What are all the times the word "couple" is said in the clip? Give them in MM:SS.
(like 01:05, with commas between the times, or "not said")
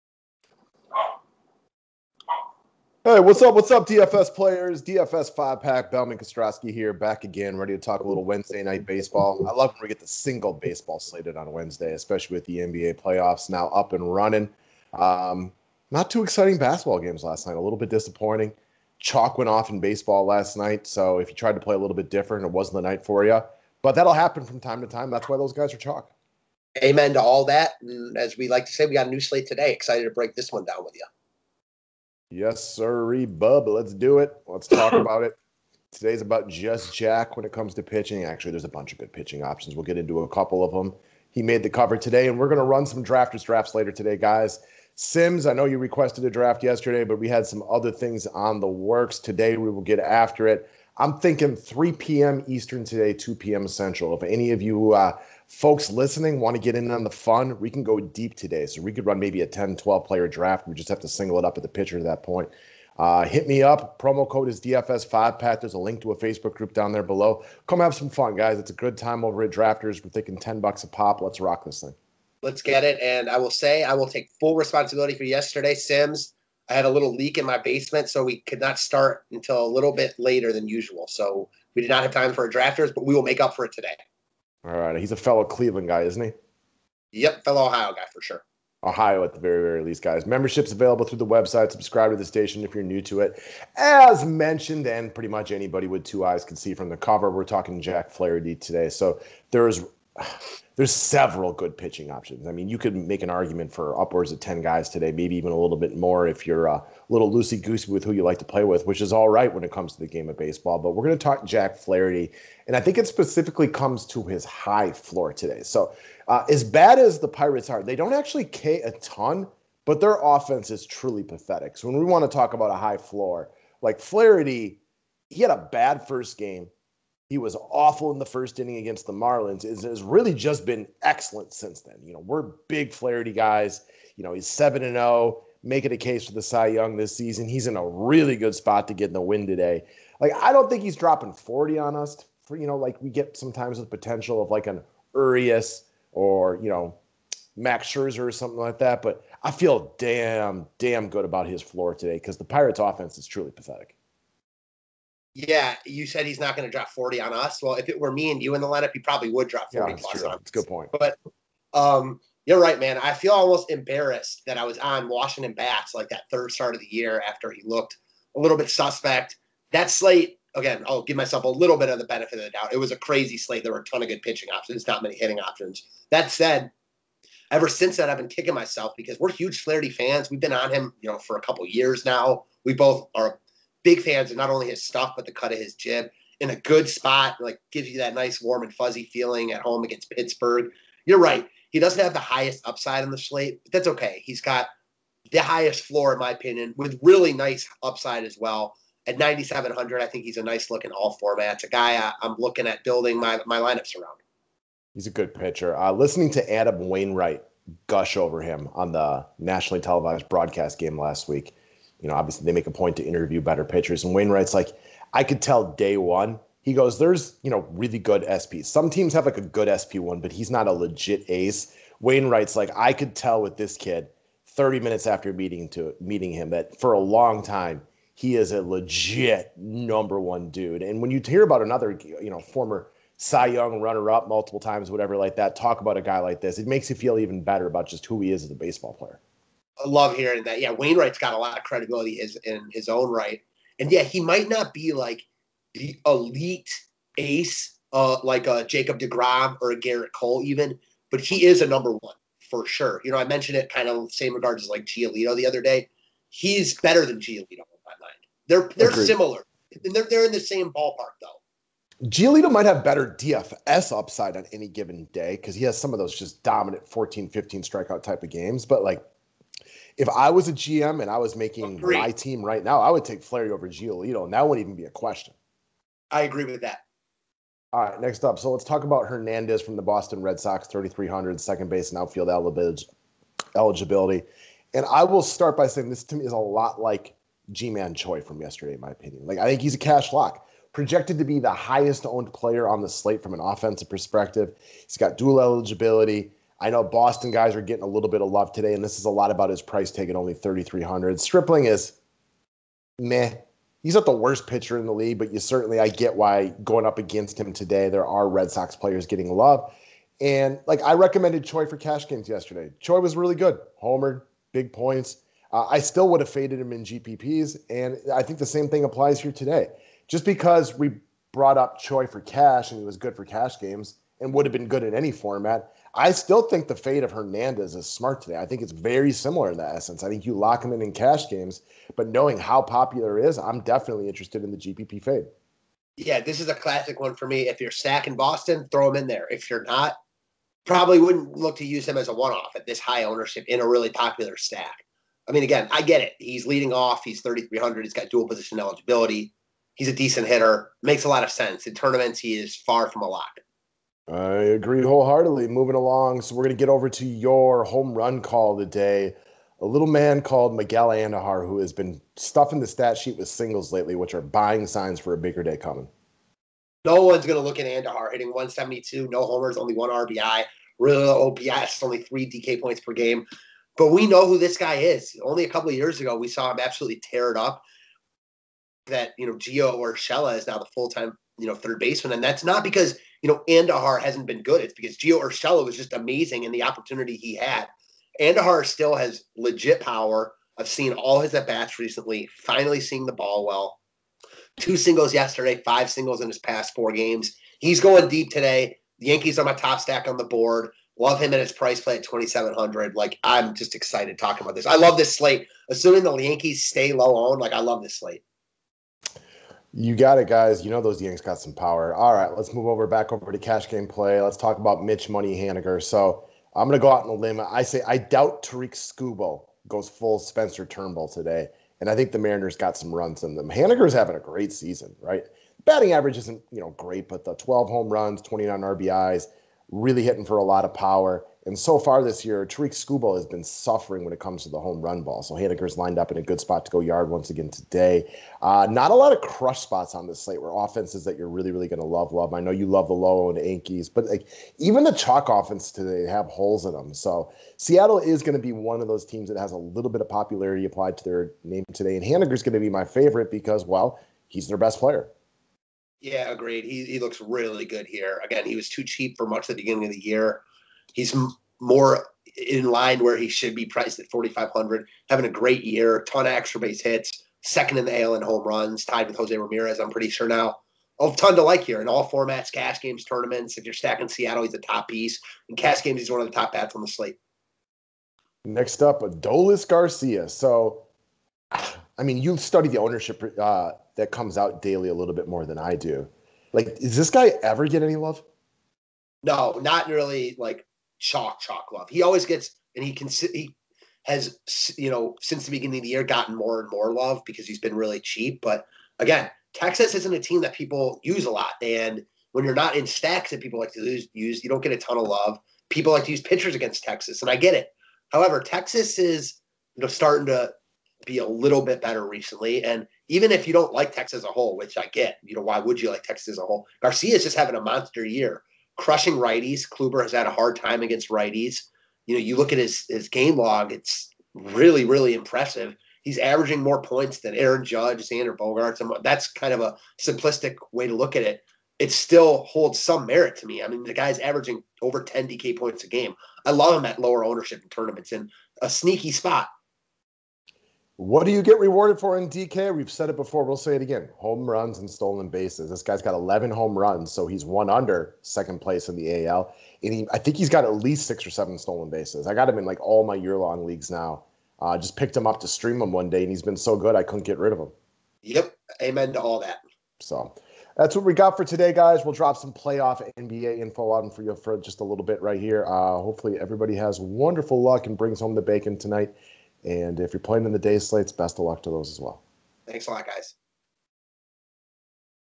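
00:40, 03:01, 06:15.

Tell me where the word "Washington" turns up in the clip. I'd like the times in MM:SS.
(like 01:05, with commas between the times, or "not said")
02:45.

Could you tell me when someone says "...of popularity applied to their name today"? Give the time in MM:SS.
07:30.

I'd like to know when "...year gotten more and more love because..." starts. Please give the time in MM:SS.
08:15.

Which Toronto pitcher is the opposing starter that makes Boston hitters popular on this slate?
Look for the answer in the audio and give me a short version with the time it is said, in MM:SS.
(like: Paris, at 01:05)
Stripling, at 05:01.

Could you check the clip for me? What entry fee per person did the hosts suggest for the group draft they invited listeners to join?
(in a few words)
10 bucks.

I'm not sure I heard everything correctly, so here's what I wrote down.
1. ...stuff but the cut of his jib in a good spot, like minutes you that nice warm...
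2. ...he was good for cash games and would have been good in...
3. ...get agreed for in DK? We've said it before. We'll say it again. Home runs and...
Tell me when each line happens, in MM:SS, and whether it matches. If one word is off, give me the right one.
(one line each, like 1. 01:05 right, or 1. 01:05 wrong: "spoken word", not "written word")
1. 03:04 wrong: "gives", not "minutes"
2. 05:22 right
3. 09:01 wrong: "rewarded", not "agreed".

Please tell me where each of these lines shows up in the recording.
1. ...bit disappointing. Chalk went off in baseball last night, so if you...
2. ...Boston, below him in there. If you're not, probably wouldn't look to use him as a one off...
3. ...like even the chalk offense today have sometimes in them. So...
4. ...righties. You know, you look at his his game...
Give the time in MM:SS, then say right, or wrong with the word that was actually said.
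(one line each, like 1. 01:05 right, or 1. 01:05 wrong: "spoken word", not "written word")
1. 00:17 right
2. 05:38 wrong: "throw", not "below"
3. 07:24 wrong: "holes", not "sometimes"
4. 08:41 right.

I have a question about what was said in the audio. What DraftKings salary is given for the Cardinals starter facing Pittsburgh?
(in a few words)
9,700.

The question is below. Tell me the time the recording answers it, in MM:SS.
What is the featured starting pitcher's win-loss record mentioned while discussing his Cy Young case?
02:14.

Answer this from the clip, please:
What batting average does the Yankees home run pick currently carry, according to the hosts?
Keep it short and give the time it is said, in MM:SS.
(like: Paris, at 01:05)
.172, at 06:08.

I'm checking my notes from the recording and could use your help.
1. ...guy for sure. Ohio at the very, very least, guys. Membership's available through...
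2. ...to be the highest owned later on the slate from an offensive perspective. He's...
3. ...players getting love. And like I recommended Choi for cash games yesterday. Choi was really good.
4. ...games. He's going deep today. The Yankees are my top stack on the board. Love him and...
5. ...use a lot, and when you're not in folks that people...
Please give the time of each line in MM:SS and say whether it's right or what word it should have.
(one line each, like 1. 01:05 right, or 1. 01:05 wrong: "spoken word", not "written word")
1. 01:27 right
2. 04:51 wrong: "player", not "later"
3. 05:08 right
4. 06:36 right
5. 08:21 wrong: "stacks", not "folks".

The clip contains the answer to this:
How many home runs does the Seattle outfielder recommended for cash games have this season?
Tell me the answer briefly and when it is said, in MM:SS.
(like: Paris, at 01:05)
12, at 07:07.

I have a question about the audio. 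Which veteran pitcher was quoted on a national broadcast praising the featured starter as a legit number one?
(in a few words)
Adam Wainwright.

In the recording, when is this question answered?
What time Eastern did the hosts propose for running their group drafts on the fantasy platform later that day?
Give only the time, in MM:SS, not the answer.
00:51.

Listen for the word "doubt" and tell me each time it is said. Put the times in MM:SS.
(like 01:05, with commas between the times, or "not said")
02:52, 06:57.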